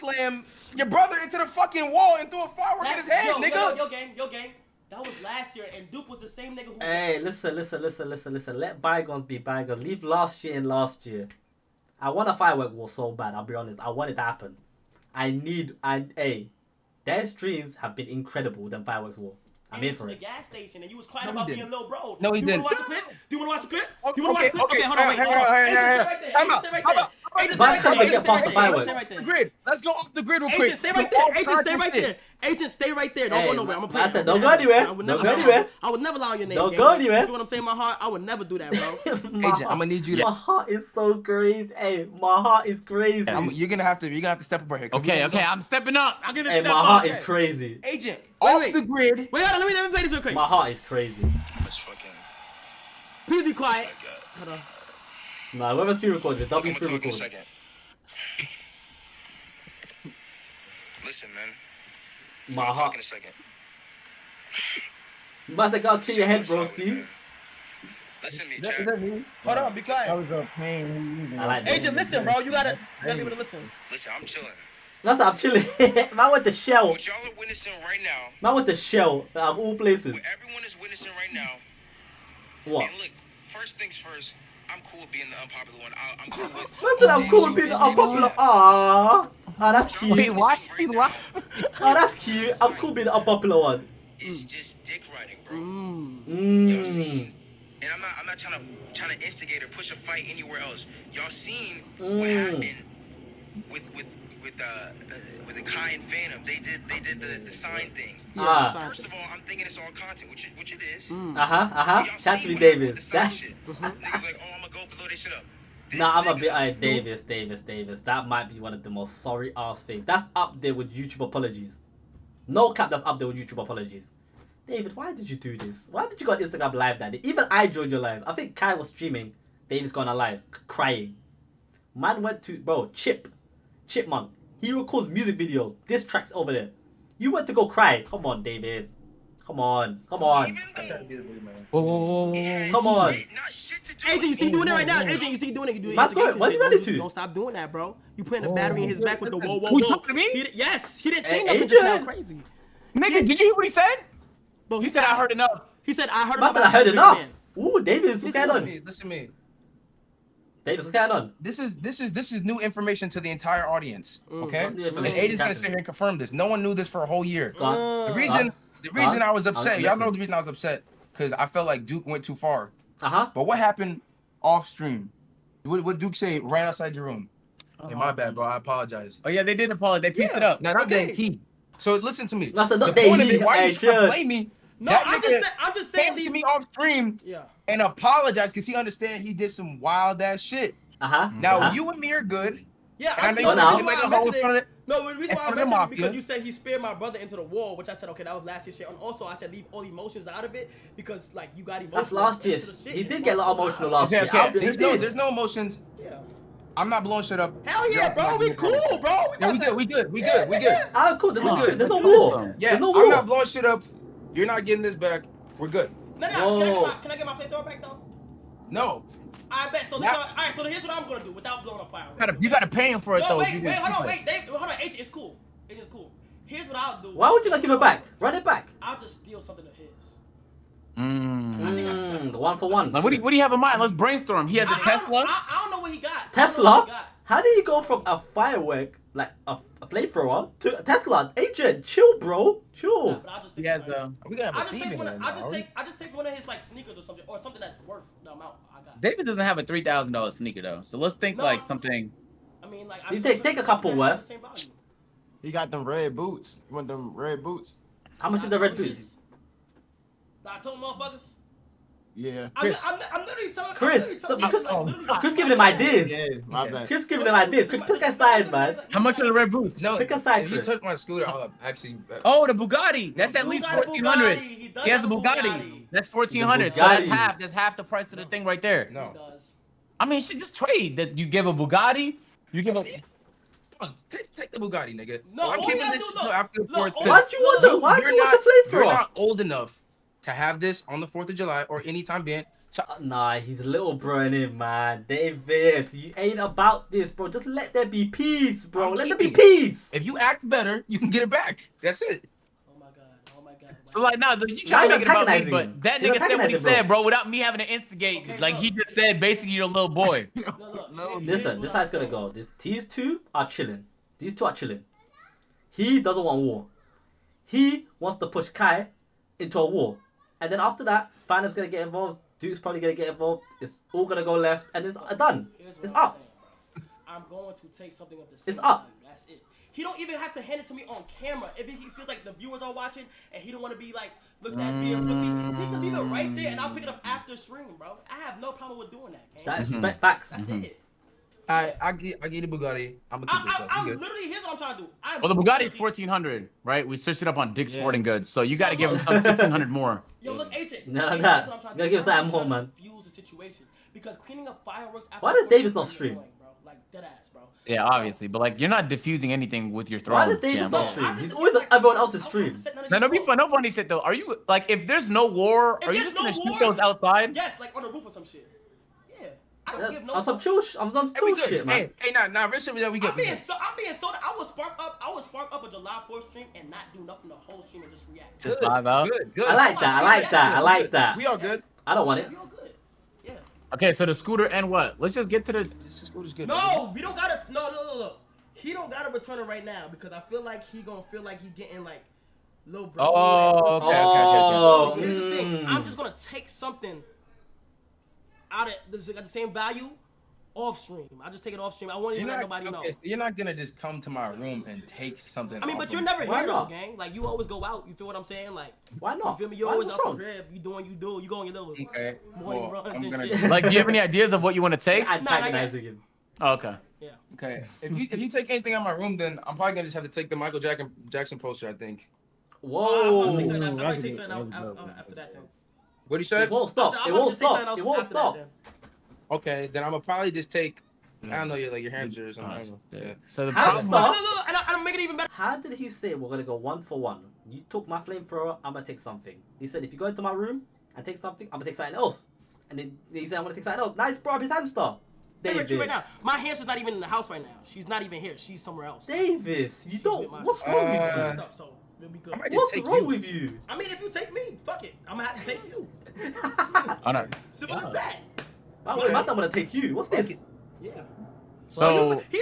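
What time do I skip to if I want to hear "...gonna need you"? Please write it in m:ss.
0:39.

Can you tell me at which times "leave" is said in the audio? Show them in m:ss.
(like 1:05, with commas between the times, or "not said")
0:09, 3:06, 3:19, 5:35.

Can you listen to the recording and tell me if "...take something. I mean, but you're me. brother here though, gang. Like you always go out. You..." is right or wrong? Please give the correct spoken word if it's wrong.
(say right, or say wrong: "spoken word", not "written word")
wrong: "never", not "brother".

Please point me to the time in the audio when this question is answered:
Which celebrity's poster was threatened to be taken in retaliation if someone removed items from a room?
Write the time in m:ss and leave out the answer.
7:00.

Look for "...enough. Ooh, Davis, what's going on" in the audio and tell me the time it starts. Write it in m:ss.
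2:36.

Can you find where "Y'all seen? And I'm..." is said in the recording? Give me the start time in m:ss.
1:36.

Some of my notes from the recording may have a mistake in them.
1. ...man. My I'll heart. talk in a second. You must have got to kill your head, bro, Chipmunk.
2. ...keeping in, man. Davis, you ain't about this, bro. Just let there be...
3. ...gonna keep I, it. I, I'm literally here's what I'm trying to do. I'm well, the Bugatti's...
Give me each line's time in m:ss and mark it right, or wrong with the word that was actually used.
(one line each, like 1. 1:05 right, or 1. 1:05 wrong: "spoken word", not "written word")
1. 1:01 wrong: "Steve", not "Chipmunk"
2. 4:53 wrong: "broing", not "keeping"
3. 5:43 right.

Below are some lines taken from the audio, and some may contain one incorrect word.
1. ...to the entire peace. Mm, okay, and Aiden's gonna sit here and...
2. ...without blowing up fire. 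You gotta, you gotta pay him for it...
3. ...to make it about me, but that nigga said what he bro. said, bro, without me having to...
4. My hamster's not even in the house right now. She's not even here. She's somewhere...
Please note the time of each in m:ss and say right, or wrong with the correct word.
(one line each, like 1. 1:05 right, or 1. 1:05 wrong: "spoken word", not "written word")
1. 2:43 wrong: "audience", not "peace"
2. 3:41 right
3. 5:04 right
4. 7:26 right.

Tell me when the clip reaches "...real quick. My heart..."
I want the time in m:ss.
0:50.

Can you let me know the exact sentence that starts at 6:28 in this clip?
He don't gotta return it right now because I feel like he gonna feel like he getting like little bro.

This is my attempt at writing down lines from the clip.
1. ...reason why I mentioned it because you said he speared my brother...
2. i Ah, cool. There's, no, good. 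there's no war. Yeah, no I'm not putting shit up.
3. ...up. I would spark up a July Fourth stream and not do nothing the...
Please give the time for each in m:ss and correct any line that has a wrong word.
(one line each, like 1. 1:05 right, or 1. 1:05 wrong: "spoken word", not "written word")
1. 3:15 right
2. 3:30 wrong: "blowing", not "putting"
3. 6:14 right.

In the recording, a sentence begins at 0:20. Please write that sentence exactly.
The gas station, and you was crying no, about being little bro.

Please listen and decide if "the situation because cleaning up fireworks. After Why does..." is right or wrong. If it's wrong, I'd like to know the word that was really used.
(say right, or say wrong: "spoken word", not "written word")
right.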